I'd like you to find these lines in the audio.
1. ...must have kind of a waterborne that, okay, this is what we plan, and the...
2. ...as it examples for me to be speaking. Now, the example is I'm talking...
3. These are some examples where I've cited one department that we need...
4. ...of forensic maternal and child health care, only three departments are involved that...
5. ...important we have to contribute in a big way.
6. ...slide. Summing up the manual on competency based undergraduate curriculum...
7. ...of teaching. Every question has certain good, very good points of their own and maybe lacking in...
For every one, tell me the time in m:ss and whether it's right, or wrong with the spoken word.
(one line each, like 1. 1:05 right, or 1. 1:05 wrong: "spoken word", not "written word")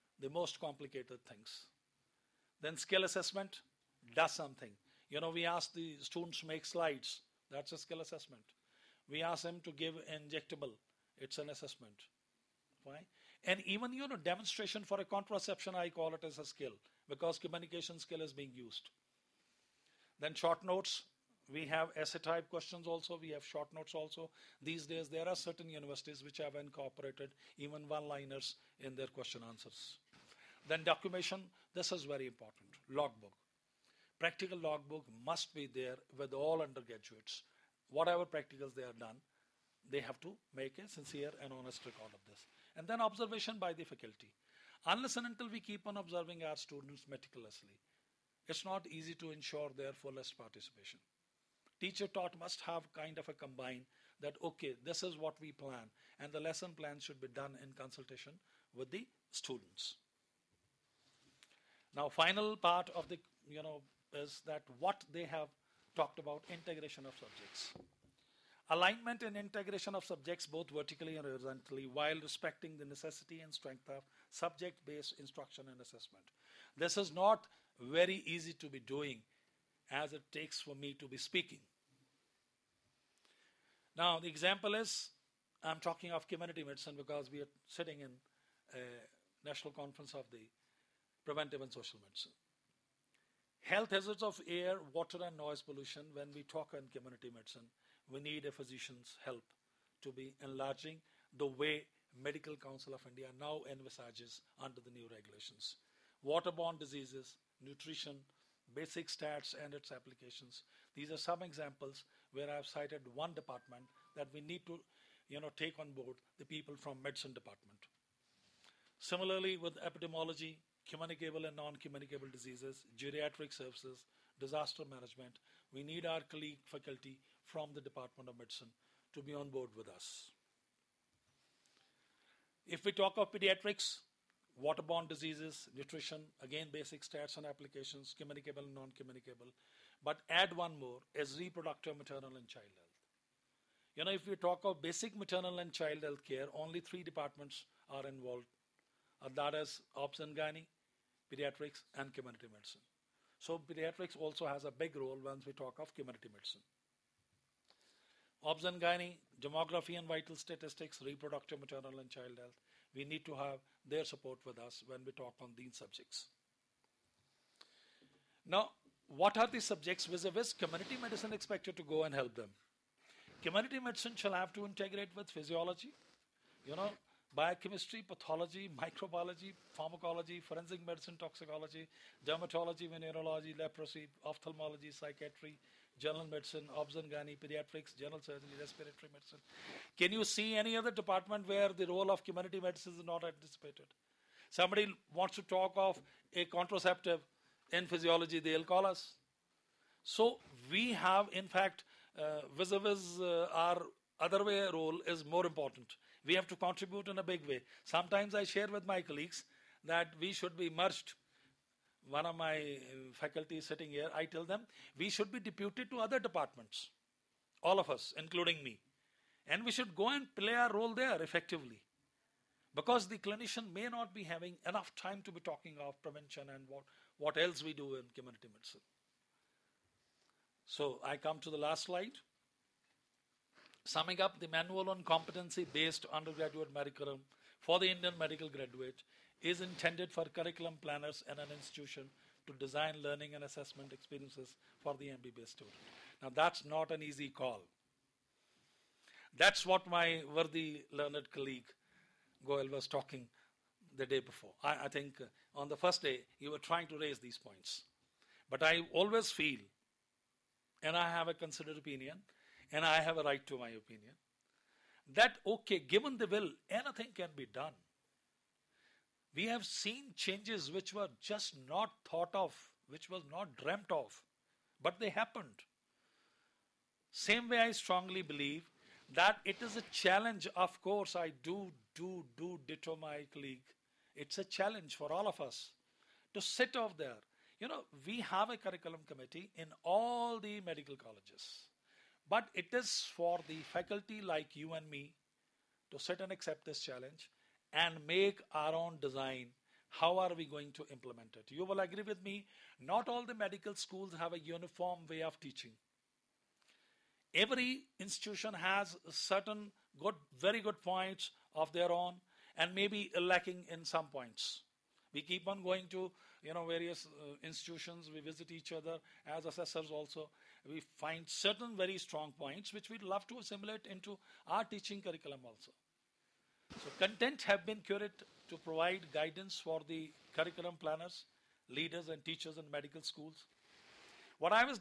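1. 0:52 wrong: "combine", not "waterborne"
2. 1:19 wrong: "takes", not "examples"
3. 1:50 right
4. 2:24 wrong: "basic", not "forensic"
5. 3:25 right
6. 3:51 right
7. 5:05 wrong: "institution", not "question".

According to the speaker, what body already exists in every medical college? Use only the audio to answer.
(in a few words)
curriculum committee.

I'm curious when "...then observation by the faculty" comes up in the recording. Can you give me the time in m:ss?
0:42.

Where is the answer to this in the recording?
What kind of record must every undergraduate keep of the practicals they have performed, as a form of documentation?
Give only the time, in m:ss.
0:34.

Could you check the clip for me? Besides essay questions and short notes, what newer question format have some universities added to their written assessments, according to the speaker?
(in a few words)
one liners.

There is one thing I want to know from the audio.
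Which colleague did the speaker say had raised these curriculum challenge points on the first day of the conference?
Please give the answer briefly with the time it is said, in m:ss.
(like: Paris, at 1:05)
Goel, at 4:12.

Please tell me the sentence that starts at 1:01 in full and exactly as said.
Now, final part of the, you know, is that what they have talked about integration of subjects.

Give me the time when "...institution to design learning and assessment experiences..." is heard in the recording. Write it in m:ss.
4:01.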